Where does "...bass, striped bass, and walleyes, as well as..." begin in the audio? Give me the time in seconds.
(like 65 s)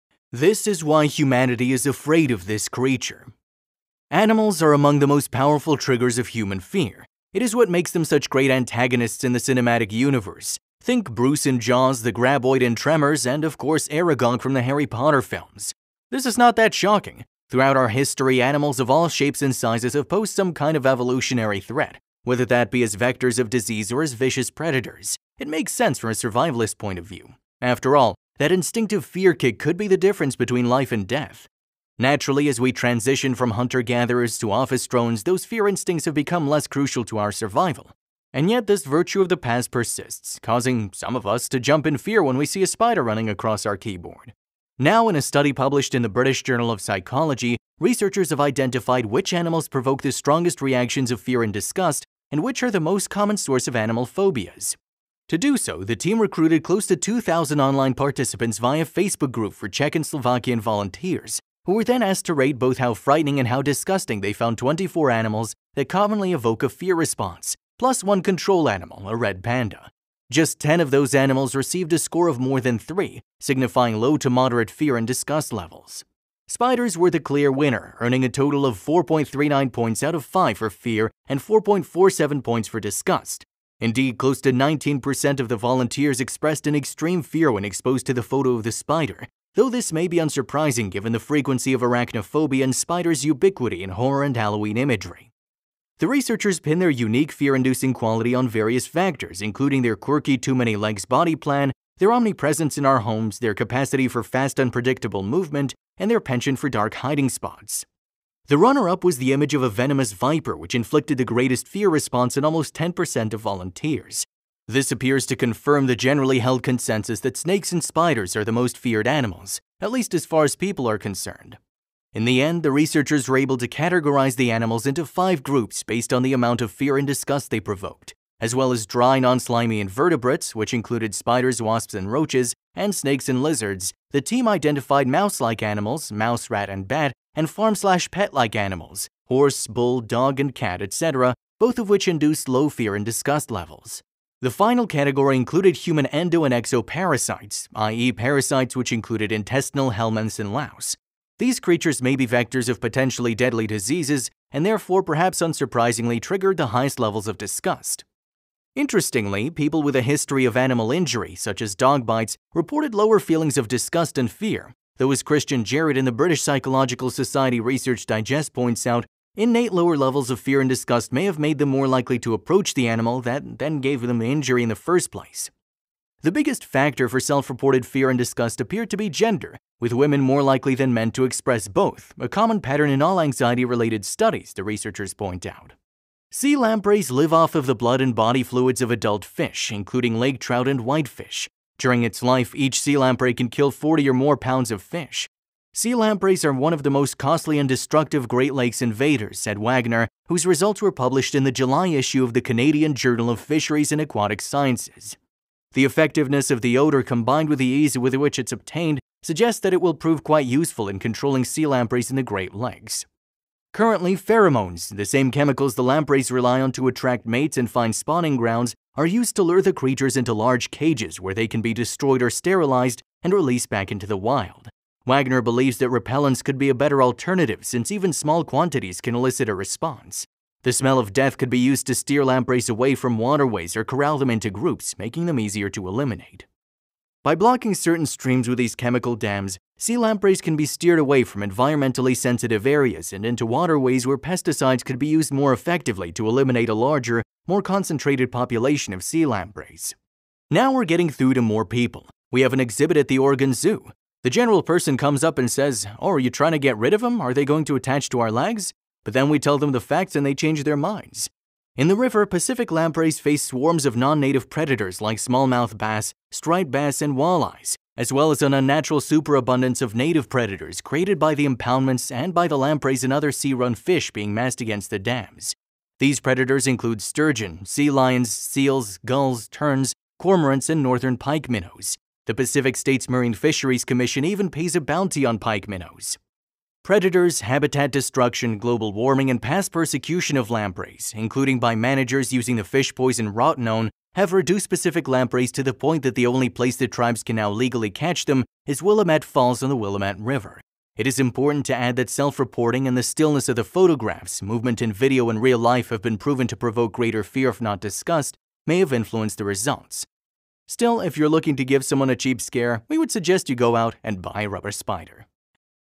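265 s.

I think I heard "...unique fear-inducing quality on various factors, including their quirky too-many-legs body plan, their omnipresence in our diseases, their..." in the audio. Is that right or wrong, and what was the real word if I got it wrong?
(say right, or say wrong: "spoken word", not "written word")
wrong: "homes", not "diseases".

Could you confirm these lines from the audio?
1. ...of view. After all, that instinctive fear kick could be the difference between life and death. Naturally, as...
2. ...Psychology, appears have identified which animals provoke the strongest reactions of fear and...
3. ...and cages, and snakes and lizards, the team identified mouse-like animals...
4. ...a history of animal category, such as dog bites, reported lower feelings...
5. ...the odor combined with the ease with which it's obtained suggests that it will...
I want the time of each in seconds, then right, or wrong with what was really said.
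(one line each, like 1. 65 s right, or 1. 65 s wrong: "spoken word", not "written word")
1. 26 s right
2. 46 s wrong: "researchers", not "appears"
3. 131 s wrong: "roaches", not "cages"
4. 159 s wrong: "injury", not "category"
5. 206 s right.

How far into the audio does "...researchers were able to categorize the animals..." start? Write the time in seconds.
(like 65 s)
122 s.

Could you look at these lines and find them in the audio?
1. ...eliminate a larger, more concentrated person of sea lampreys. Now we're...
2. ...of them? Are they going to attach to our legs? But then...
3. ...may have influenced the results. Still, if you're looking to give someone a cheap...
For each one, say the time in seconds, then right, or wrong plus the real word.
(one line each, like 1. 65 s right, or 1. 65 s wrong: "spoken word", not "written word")
1. 246 s wrong: "population", not "person"
2. 256 s right
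3. 308 s right.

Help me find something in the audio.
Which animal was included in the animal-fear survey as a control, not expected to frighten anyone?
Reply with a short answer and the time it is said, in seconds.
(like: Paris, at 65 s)
red panda, at 69 s.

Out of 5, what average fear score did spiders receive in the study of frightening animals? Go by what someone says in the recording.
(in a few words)
4.39.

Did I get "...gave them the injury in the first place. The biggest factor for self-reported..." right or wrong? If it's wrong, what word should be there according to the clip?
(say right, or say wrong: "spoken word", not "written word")
right.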